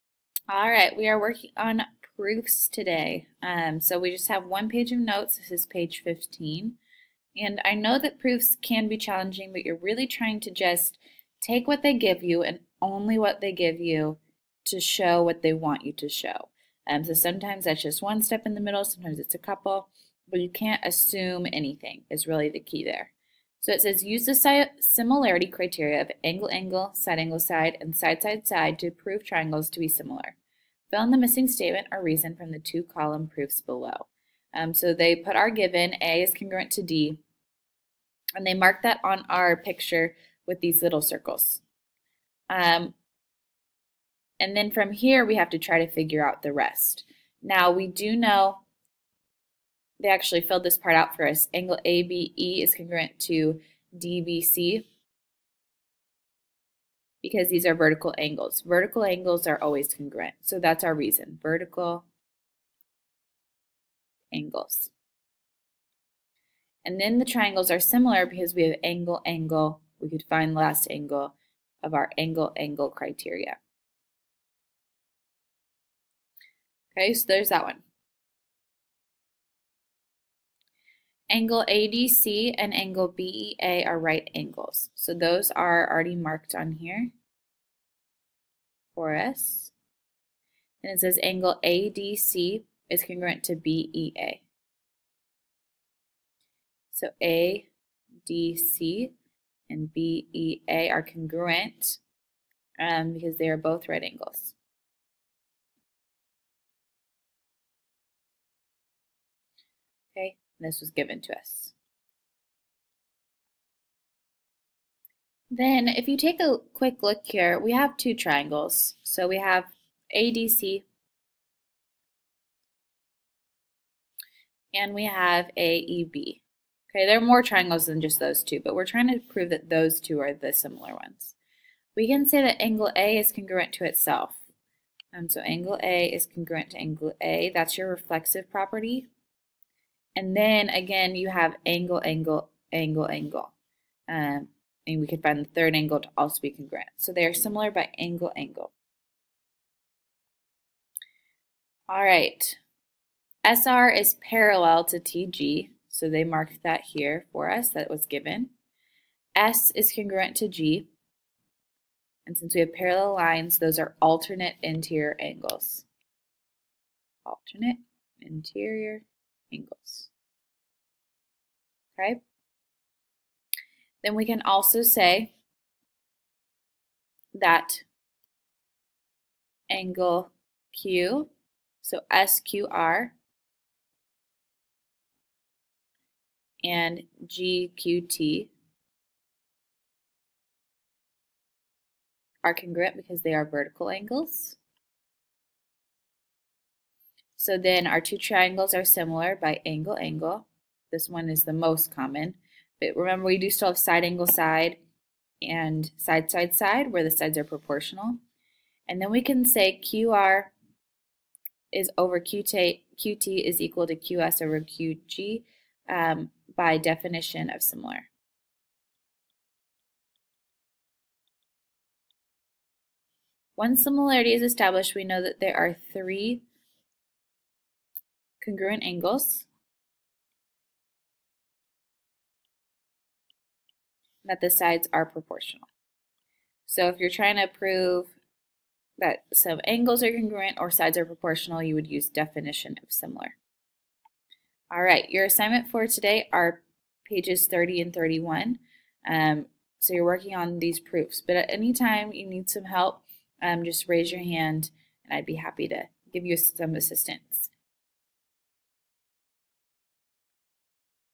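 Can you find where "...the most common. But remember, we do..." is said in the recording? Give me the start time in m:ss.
3:21.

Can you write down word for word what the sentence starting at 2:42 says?
And since we have parallel lines, those are alternate interior angles.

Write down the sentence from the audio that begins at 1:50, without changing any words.
Okay, and this was given to us.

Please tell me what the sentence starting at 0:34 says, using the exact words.
Um, so they put our given, A is congruent to D, and they mark that on our picture with these little circles.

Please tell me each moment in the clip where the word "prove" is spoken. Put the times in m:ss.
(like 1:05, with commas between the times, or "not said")
0:28, 2:09, 3:57.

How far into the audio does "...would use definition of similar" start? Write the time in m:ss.
4:01.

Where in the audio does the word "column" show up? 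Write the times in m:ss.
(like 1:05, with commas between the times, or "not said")
0:32.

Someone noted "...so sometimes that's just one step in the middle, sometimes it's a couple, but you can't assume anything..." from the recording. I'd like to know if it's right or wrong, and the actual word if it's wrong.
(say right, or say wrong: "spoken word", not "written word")
right.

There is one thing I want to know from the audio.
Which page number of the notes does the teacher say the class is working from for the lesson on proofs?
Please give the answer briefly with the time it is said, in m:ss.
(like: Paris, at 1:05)
15, at 0:05.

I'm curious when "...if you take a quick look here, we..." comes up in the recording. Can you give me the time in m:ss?
1:55.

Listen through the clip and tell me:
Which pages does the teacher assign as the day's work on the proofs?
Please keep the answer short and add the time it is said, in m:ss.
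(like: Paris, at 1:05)
30 and 31, at 4:07.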